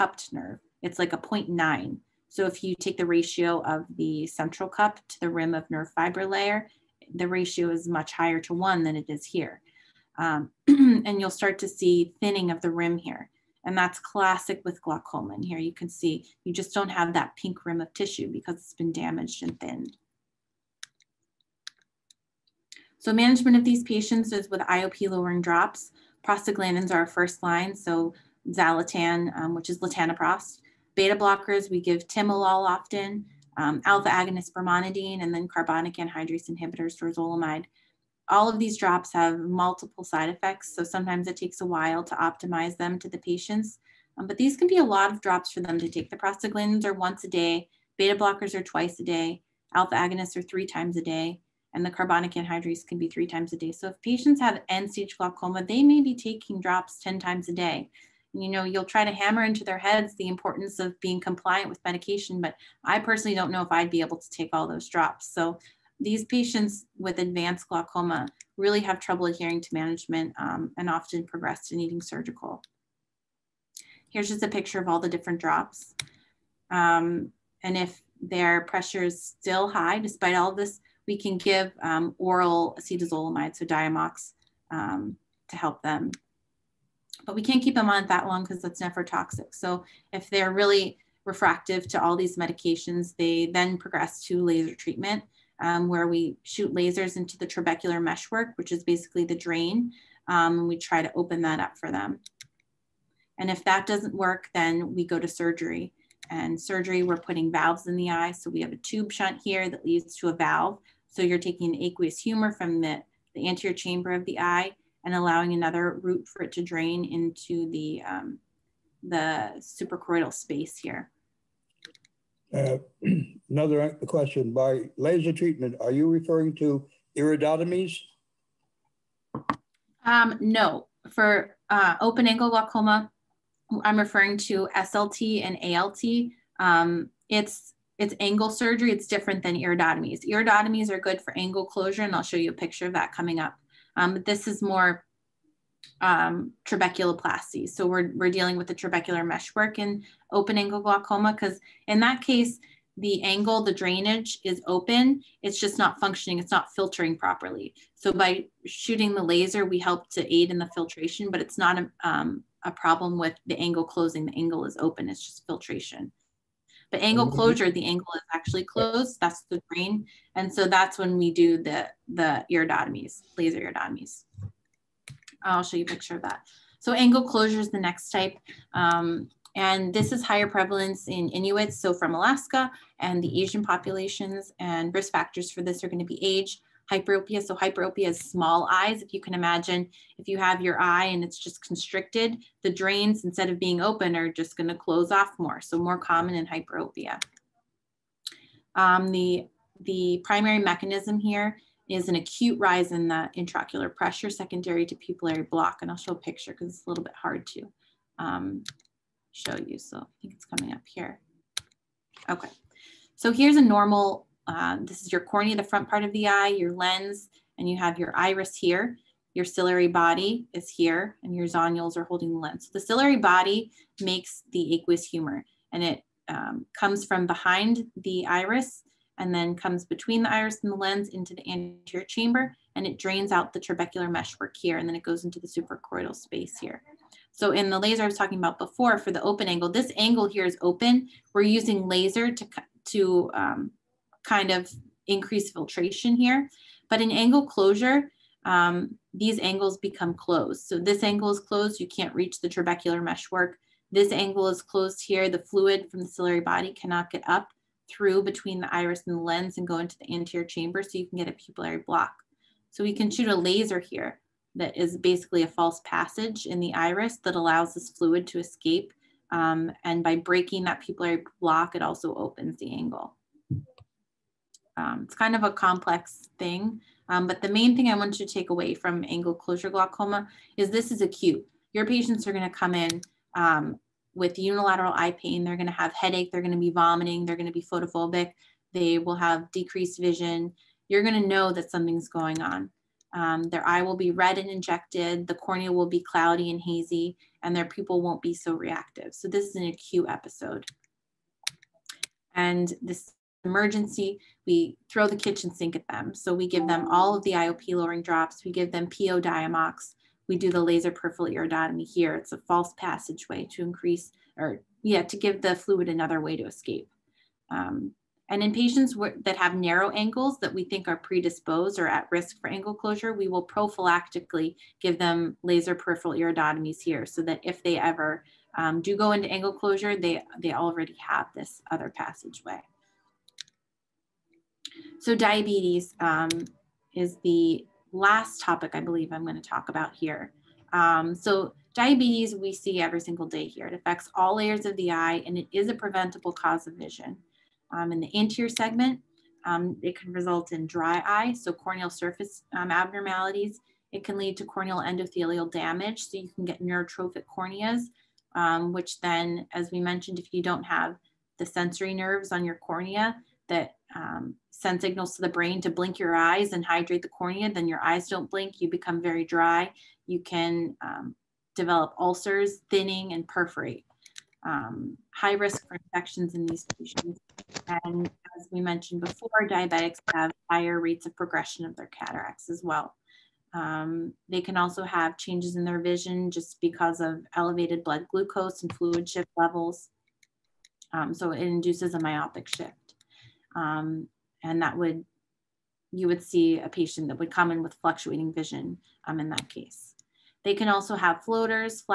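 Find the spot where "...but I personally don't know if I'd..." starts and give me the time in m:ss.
1:02.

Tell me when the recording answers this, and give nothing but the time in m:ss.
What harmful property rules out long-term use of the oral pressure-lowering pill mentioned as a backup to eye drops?
1:28.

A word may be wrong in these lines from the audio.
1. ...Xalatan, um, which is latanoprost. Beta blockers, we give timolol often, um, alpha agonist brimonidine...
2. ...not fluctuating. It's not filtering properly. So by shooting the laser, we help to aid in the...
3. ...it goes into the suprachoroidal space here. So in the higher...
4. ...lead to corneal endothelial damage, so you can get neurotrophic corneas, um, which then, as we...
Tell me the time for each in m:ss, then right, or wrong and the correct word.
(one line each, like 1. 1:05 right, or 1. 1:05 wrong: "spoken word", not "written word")
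1. 0:28 right
2. 2:35 wrong: "functioning", not "fluctuating"
3. 3:54 wrong: "laser", not "higher"
4. 5:54 right.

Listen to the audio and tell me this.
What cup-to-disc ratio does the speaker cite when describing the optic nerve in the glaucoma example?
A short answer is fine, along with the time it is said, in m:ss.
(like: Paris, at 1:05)
0.9, at 0:01.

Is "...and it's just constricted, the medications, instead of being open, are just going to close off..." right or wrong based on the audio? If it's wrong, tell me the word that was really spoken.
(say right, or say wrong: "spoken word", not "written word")
wrong: "drains", not "medications".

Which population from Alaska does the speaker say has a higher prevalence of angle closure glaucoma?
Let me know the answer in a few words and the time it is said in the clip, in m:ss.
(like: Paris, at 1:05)
Inuits, at 3:01.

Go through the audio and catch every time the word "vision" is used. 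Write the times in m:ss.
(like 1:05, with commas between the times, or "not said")
4:50, 5:46, 6:25, 6:38.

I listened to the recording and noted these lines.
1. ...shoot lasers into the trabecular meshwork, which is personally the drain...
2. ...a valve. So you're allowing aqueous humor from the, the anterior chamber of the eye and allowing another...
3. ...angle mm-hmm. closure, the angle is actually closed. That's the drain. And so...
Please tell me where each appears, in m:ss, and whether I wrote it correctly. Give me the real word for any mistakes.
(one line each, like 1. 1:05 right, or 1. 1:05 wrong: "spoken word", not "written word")
1. 1:36 wrong: "basically", not "personally"
2. 1:50 wrong: "taking", not "allowing"
3. 2:47 right.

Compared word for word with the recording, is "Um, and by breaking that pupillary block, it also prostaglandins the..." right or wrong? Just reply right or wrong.
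wrong.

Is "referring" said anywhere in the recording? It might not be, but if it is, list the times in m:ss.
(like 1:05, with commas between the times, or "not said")
2:06, 2:13.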